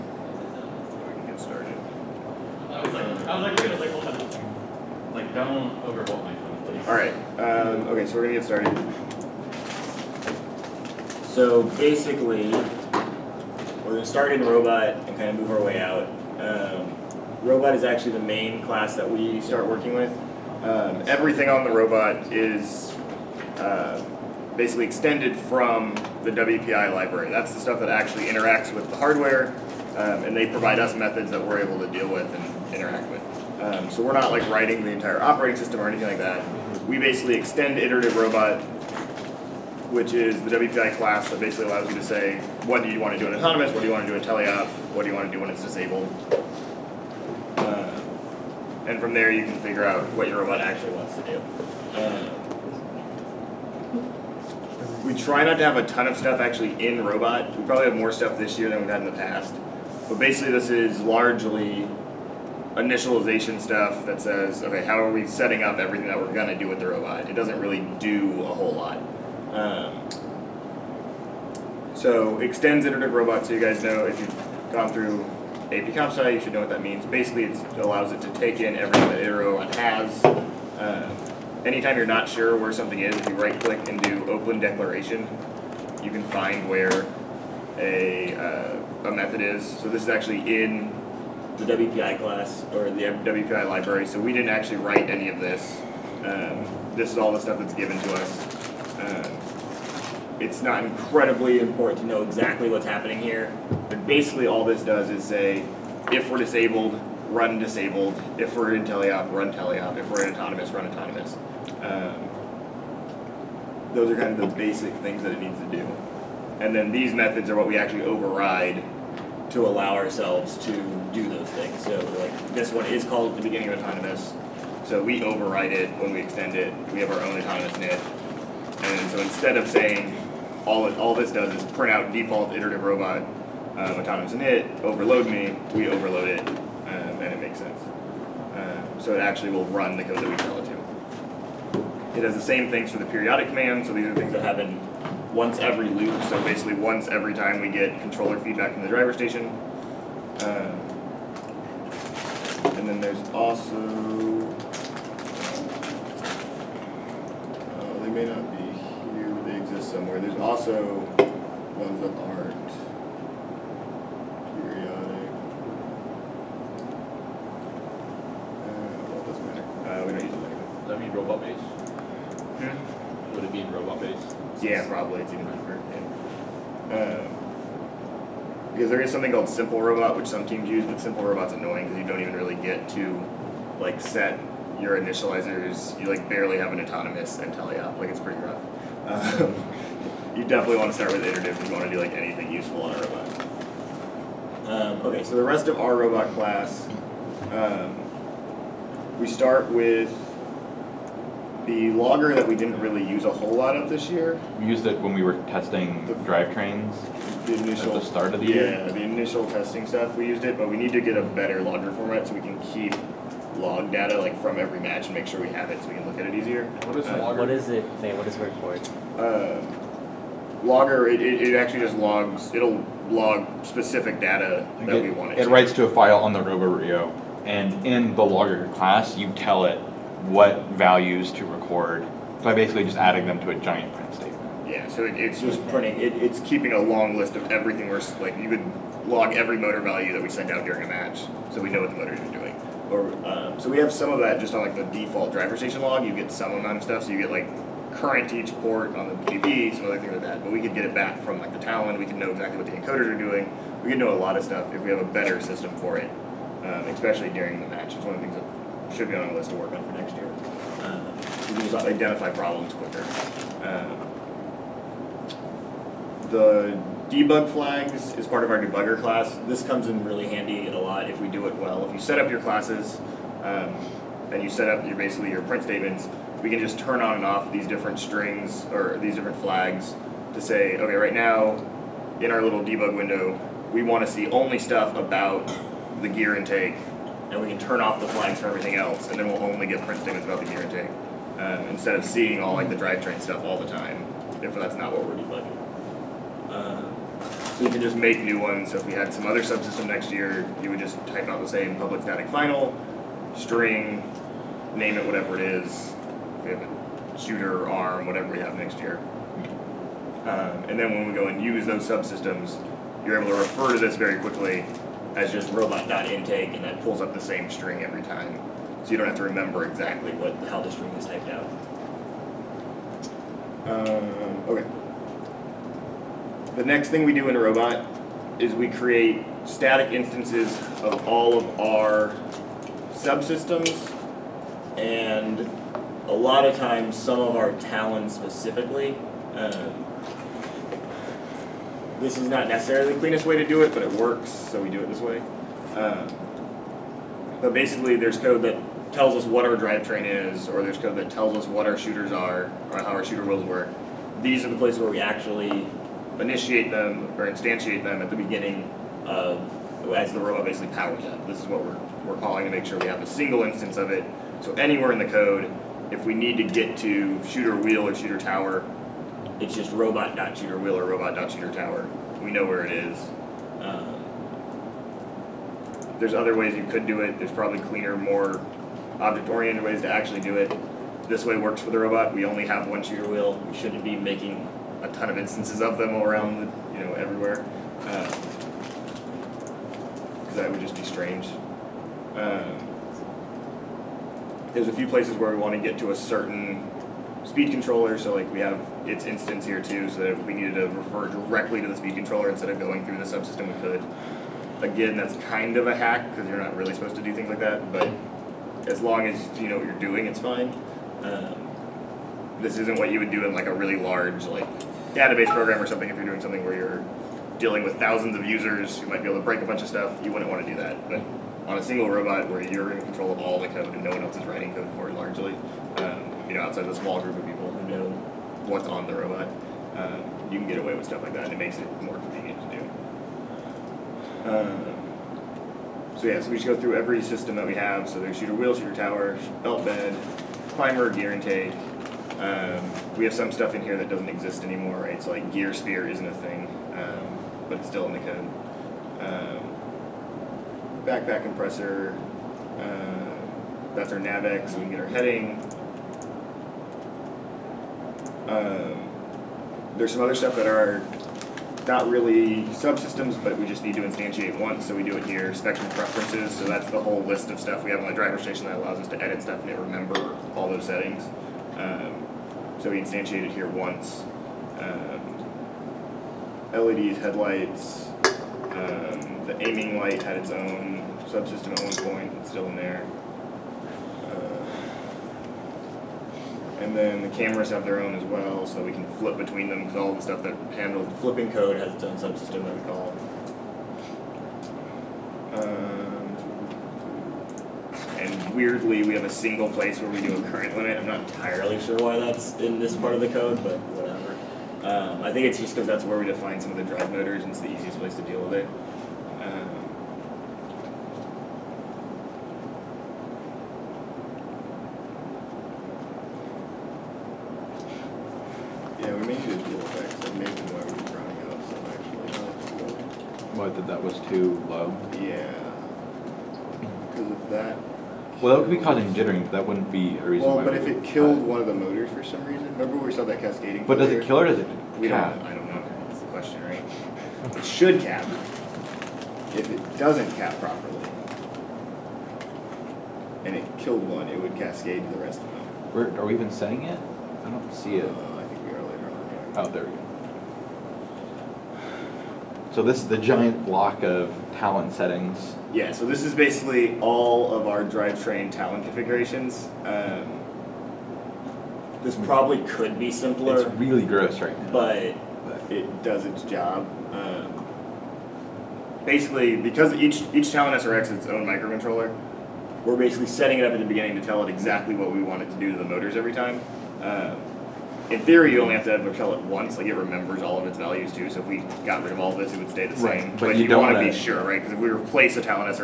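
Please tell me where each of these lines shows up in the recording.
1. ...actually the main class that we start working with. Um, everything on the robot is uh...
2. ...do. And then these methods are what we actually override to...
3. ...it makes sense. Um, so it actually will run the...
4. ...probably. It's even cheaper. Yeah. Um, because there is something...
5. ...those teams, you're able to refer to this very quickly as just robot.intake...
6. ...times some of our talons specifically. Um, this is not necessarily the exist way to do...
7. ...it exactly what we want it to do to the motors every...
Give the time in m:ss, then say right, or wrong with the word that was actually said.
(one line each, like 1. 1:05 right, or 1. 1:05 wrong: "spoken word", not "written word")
1. 0:17 right
2. 1:55 right
3. 2:17 right
4. 2:54 right
5. 5:11 wrong: "subsystems", not "teams"
6. 5:36 wrong: "cleanest", not "exist"
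7. 9:34 right.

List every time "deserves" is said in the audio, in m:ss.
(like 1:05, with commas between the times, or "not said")
not said.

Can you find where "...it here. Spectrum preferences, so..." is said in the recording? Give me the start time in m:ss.
7:44.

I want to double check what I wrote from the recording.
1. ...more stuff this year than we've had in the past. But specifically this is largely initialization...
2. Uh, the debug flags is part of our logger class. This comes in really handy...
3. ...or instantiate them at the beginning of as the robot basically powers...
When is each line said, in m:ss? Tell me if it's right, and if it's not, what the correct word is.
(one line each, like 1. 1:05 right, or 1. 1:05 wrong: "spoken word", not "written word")
1. 0:57 wrong: "basically", not "specifically"
2. 4:23 wrong: "debugger", not "logger"
3. 5:57 right.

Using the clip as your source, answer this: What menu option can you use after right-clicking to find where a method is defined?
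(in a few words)
Open Declaration.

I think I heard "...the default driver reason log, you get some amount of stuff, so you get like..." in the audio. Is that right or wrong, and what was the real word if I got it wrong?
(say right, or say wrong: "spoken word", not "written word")
wrong: "station", not "reason".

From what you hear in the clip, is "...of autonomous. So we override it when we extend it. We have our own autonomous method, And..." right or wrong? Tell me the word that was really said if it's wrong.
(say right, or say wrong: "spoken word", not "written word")
right.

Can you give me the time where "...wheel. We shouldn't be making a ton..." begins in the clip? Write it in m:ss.
6:23.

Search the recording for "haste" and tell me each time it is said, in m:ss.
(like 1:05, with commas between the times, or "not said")
not said.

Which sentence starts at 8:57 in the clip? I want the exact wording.
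It should cap, if it doesn't cap properly.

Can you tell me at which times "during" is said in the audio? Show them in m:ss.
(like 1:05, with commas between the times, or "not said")
4:00, 4:17.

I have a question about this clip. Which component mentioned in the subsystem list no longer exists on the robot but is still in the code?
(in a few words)
gear spear.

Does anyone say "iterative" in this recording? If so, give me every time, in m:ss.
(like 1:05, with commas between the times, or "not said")
0:37, 1:12, 2:12, 3:11.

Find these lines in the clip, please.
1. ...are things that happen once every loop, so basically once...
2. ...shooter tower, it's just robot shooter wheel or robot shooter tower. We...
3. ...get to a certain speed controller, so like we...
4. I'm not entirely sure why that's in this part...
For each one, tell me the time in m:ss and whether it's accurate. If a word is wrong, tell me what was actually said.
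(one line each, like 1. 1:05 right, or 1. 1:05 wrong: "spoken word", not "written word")
1. 2:24 right
2. 6:07 right
3. 6:35 right
4. 8:20 right.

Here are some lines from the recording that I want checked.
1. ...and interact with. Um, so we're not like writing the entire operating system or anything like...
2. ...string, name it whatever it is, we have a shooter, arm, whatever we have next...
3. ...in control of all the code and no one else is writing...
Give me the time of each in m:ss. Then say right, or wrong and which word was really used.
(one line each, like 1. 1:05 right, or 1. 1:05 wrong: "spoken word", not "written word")
1. 0:32 right
2. 5:03 right
3. 7:02 right.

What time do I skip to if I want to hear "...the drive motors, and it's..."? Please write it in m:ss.
8:26.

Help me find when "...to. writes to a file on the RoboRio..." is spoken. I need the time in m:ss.
3:45.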